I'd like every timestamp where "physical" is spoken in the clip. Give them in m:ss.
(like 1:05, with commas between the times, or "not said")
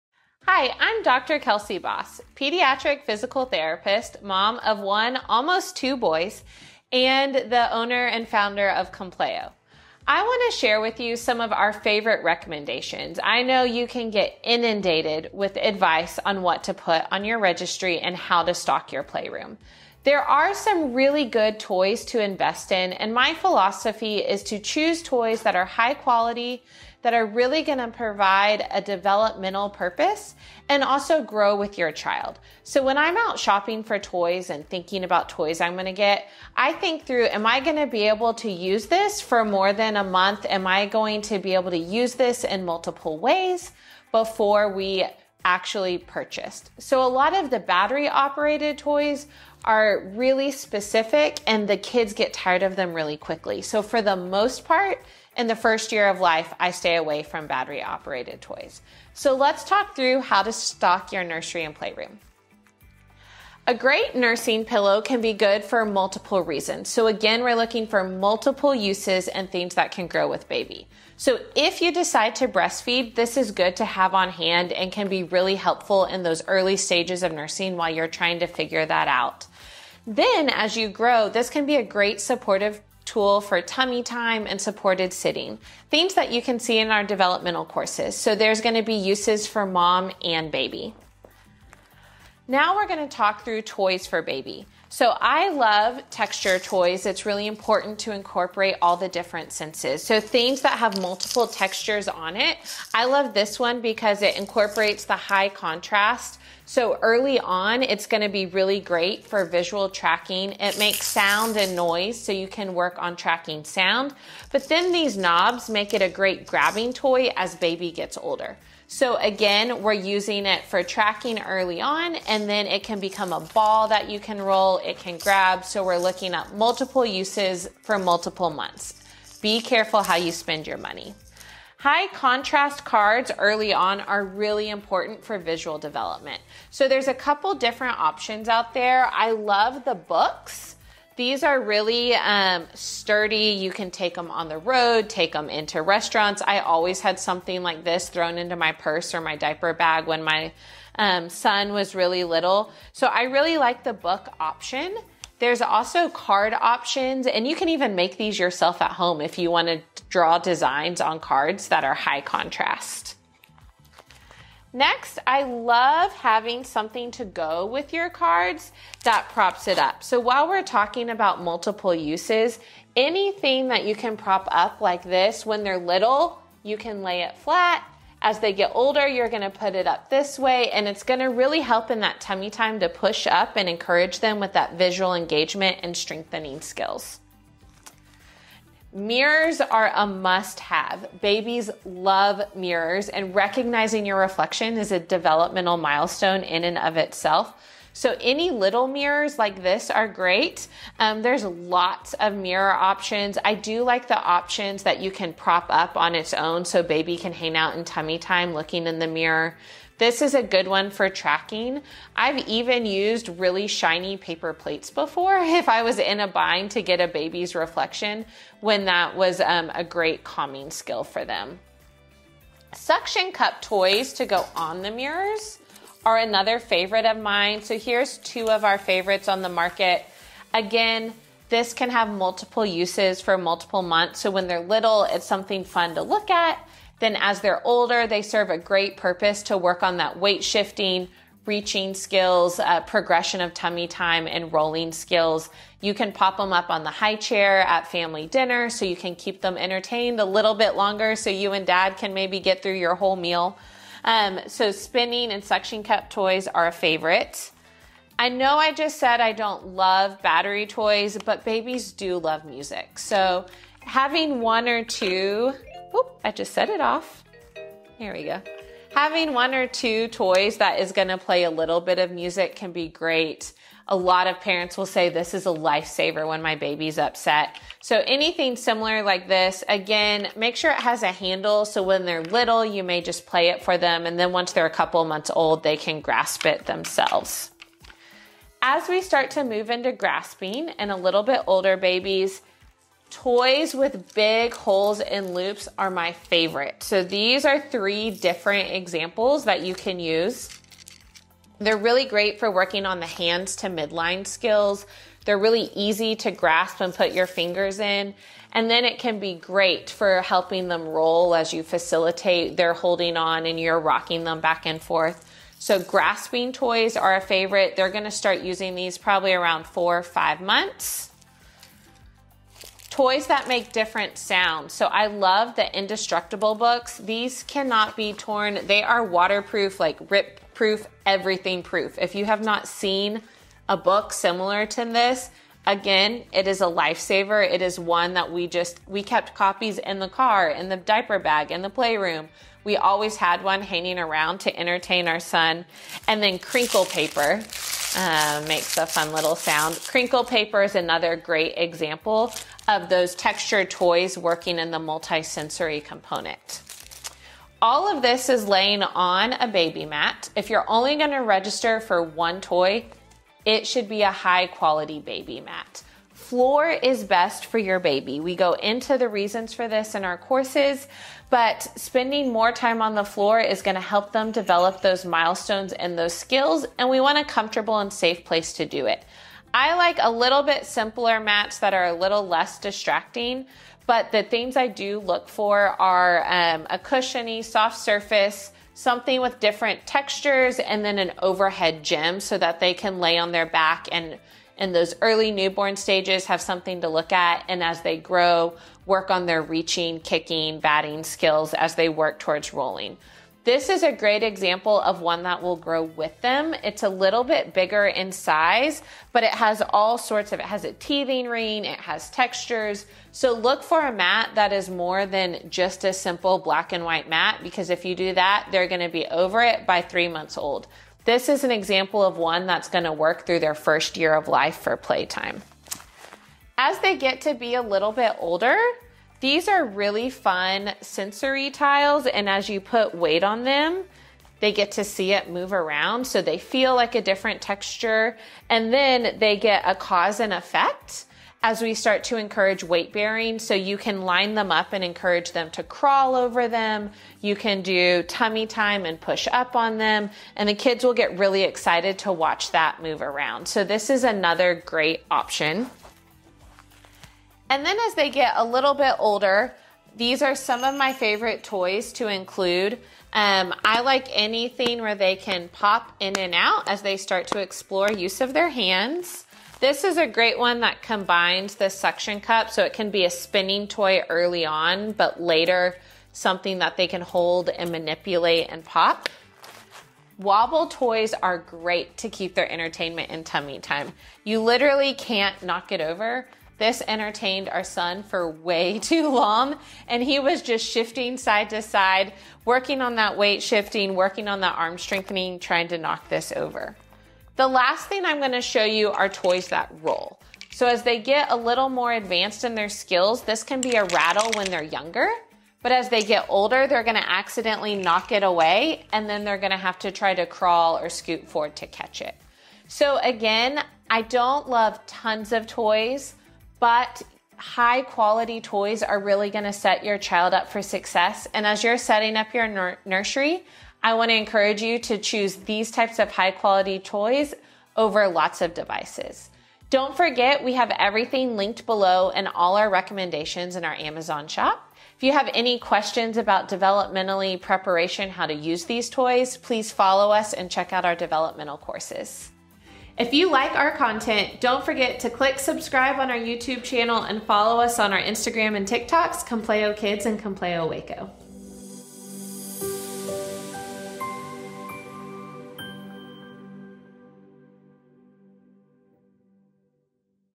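0:03.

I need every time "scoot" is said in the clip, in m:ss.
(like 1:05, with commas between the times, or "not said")
8:30.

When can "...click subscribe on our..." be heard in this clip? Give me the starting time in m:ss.
9:05.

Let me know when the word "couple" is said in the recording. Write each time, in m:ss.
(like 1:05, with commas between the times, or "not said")
2:17, 4:44.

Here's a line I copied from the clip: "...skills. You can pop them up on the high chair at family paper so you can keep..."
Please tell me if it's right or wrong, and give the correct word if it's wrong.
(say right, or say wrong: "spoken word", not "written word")
wrong: "dinner", not "paper".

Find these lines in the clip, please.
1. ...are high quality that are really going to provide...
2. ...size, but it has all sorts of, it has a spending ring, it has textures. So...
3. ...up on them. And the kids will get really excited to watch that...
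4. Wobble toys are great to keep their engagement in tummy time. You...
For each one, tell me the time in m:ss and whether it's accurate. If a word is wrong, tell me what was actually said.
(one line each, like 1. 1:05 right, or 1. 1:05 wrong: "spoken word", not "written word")
1. 0:25 right
2. 6:48 wrong: "teething", not "spending"
3. 7:29 right
4. 8:00 wrong: "entertainment", not "engagement".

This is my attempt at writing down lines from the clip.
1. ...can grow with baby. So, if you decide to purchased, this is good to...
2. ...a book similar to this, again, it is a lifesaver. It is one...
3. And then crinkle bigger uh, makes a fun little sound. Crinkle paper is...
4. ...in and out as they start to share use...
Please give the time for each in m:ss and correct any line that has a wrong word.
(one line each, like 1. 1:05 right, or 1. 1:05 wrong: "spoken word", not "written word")
1. 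1:09 wrong: "breastfeed", not "purchased"
2. 5:33 right
3. 5:46 wrong: "paper", not "bigger"
4. 7:45 wrong: "explore", not "share".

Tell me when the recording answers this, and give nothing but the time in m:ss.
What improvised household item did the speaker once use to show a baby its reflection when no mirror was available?
3:33.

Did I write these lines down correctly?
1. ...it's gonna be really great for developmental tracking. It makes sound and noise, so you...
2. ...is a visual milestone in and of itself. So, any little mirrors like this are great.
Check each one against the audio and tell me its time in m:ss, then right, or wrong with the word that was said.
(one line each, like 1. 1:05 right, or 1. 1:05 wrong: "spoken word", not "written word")
1. 1:47 wrong: "visual", not "developmental"
2. 3:14 wrong: "developmental", not "visual".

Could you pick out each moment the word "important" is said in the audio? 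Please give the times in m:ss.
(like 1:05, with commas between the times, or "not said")
1:37, 2:14.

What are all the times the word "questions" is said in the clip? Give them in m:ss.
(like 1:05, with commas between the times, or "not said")
8:55.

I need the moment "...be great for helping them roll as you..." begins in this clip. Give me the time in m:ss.
5:09.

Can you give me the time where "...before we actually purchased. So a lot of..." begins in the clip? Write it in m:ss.
0:44.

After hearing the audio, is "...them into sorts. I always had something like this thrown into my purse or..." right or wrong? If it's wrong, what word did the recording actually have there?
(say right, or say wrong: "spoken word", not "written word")
wrong: "restaurants", not "sorts".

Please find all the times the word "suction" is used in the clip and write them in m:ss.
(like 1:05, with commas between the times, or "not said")
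3:42, 4:15, 7:51.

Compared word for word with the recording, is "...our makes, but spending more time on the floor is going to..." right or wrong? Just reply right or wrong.
wrong.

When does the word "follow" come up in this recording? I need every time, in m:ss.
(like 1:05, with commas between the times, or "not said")
8:59, 9:07.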